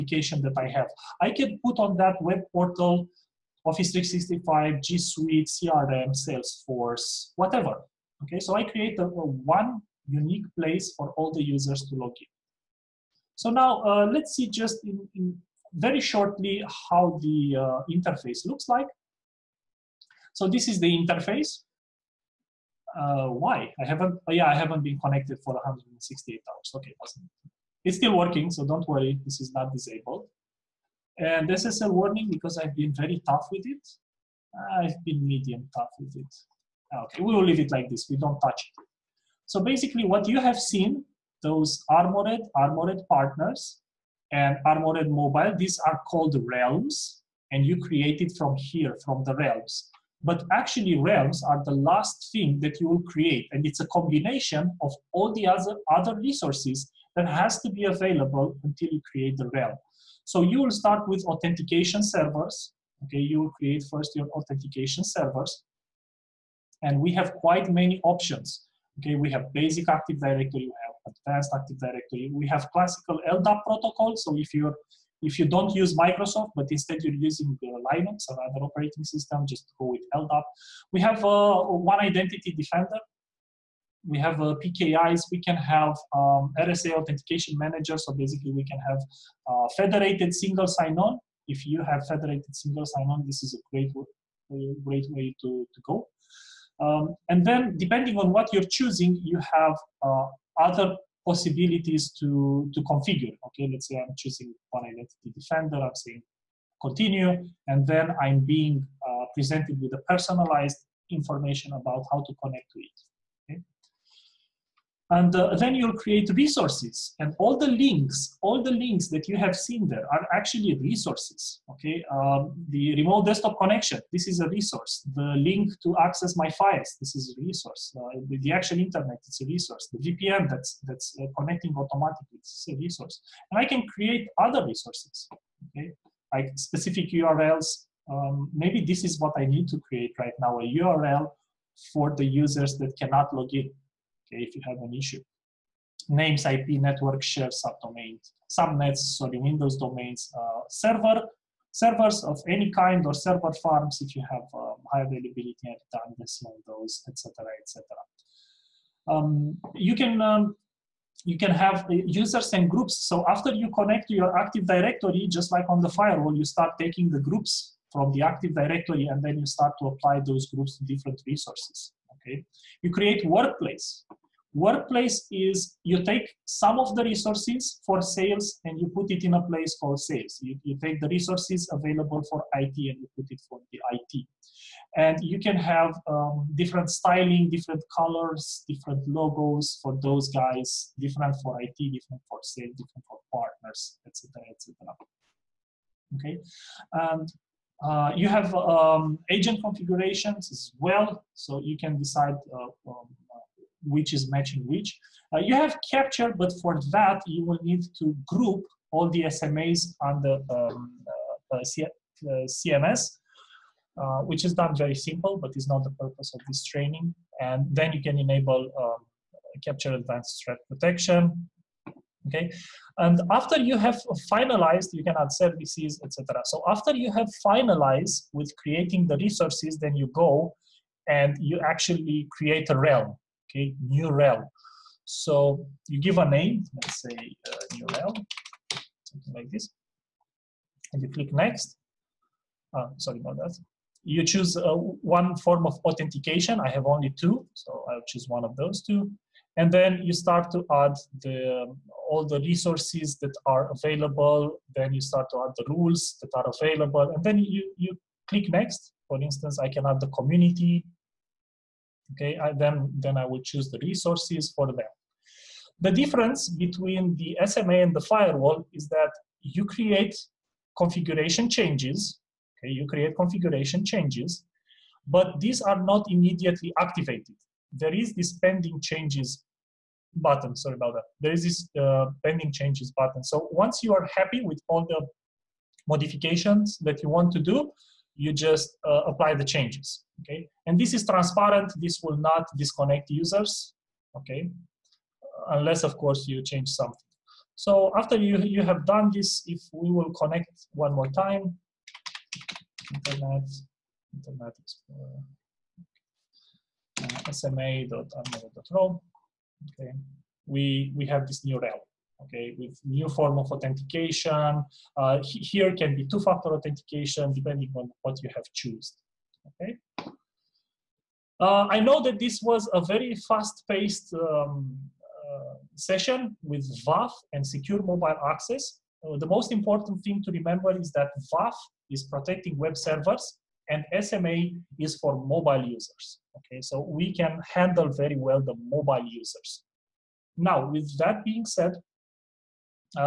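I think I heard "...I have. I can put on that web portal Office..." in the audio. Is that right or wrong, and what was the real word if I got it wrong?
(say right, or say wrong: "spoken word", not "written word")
right.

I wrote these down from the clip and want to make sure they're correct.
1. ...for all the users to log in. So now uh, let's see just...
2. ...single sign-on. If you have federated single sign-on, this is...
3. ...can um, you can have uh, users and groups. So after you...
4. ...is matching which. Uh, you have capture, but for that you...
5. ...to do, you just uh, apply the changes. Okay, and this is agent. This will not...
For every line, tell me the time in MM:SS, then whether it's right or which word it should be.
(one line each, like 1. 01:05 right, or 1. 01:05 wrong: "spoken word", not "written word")
1. 00:10 right
2. 01:30 right
3. 02:39 right
4. 03:24 right
5. 04:47 wrong: "transparent", not "agent".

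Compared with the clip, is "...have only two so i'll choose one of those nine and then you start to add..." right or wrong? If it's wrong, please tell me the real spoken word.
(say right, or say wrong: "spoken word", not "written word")
wrong: "two", not "nine".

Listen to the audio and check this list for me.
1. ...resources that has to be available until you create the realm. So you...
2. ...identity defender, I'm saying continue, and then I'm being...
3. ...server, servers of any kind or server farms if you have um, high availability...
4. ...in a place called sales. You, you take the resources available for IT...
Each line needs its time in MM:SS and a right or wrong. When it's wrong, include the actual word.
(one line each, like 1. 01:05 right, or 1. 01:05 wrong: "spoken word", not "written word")
1. 00:56 right
2. 01:44 right
3. 02:30 right
4. 02:59 right.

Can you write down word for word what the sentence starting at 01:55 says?
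And uh, then you'll create resources and all the links, all the links that you have seen there are actually resources, okay?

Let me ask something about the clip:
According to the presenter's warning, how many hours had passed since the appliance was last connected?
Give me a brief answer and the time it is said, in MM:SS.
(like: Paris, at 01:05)
168, at 00:25.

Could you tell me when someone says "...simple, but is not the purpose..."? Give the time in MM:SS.
03:34.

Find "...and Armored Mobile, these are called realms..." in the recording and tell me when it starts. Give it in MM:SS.
00:44.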